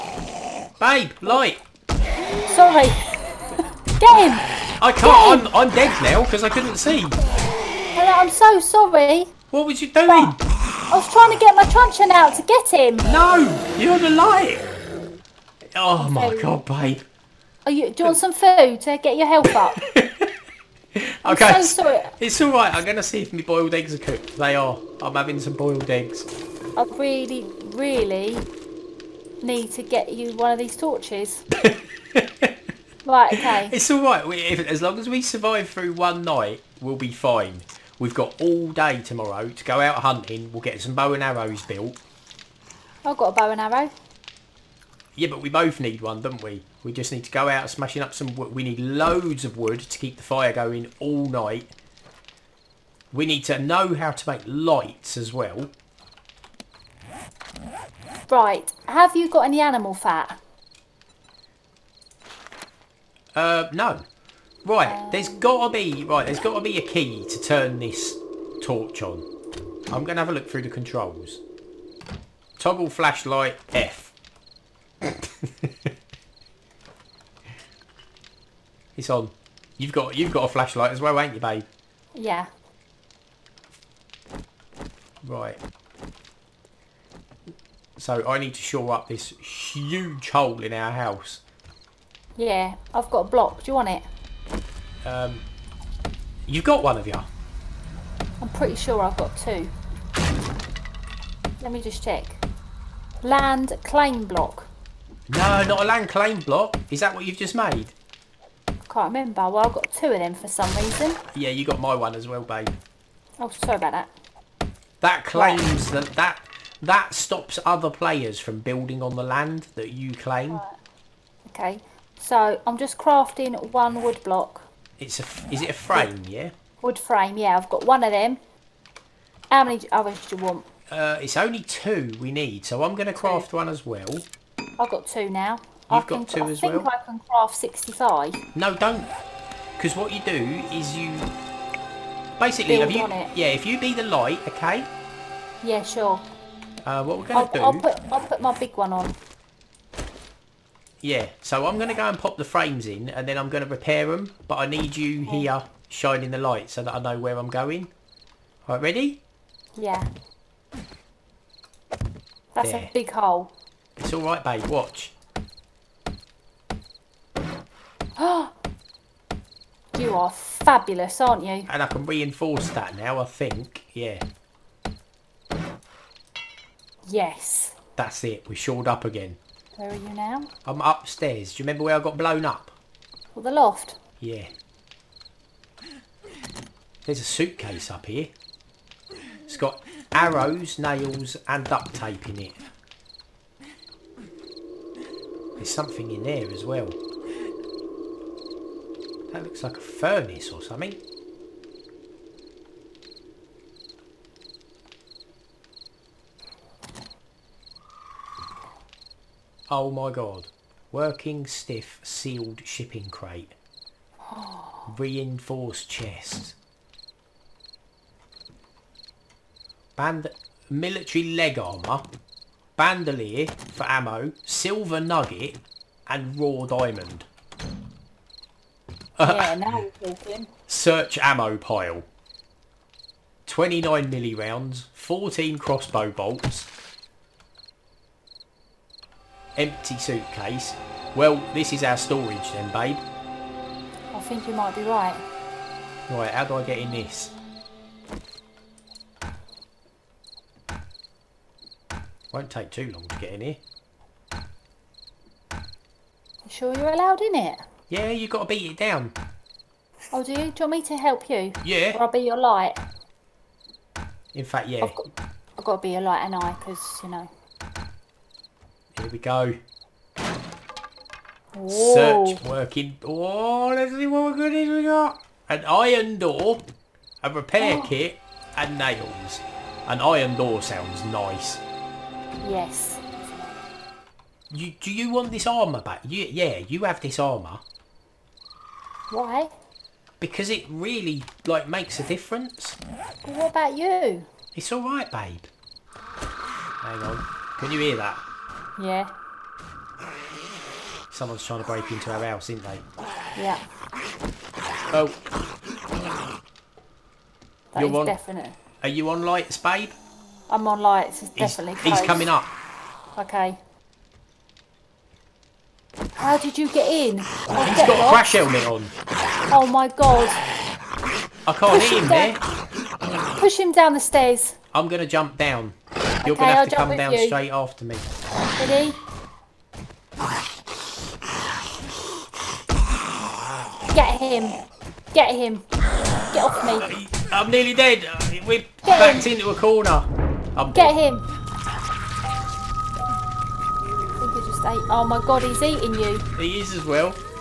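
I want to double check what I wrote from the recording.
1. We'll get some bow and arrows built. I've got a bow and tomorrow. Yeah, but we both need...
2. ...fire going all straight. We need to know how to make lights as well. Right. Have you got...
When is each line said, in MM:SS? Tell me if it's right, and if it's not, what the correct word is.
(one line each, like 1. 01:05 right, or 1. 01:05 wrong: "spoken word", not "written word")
1. 00:40 wrong: "arrow", not "tomorrow"
2. 00:50 wrong: "night", not "straight".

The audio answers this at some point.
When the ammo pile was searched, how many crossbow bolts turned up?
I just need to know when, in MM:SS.
03:54.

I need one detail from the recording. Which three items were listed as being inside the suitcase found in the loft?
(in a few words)
Arrows, nails and duct tape.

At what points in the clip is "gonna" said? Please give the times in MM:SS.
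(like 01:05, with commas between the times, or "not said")
00:22, 01:10.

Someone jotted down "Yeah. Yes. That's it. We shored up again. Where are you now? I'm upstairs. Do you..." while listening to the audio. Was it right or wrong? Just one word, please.
right.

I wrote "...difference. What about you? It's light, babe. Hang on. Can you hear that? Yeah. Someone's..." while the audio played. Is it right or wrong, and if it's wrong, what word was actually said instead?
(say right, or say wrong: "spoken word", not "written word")
wrong: "alright", not "light".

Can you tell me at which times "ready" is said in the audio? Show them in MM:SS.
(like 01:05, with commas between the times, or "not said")
02:38, 05:28.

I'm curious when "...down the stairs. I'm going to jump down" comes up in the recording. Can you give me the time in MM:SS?
05:23.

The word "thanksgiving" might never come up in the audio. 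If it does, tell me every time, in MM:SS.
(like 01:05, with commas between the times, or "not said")
not said.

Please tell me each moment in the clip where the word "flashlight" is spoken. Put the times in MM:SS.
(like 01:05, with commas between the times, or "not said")
01:12, 01:20.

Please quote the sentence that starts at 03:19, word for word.
That looks like a furnace or something.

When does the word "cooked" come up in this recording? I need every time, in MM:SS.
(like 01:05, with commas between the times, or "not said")
00:23.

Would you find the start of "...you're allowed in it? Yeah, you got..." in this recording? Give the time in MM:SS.
04:16.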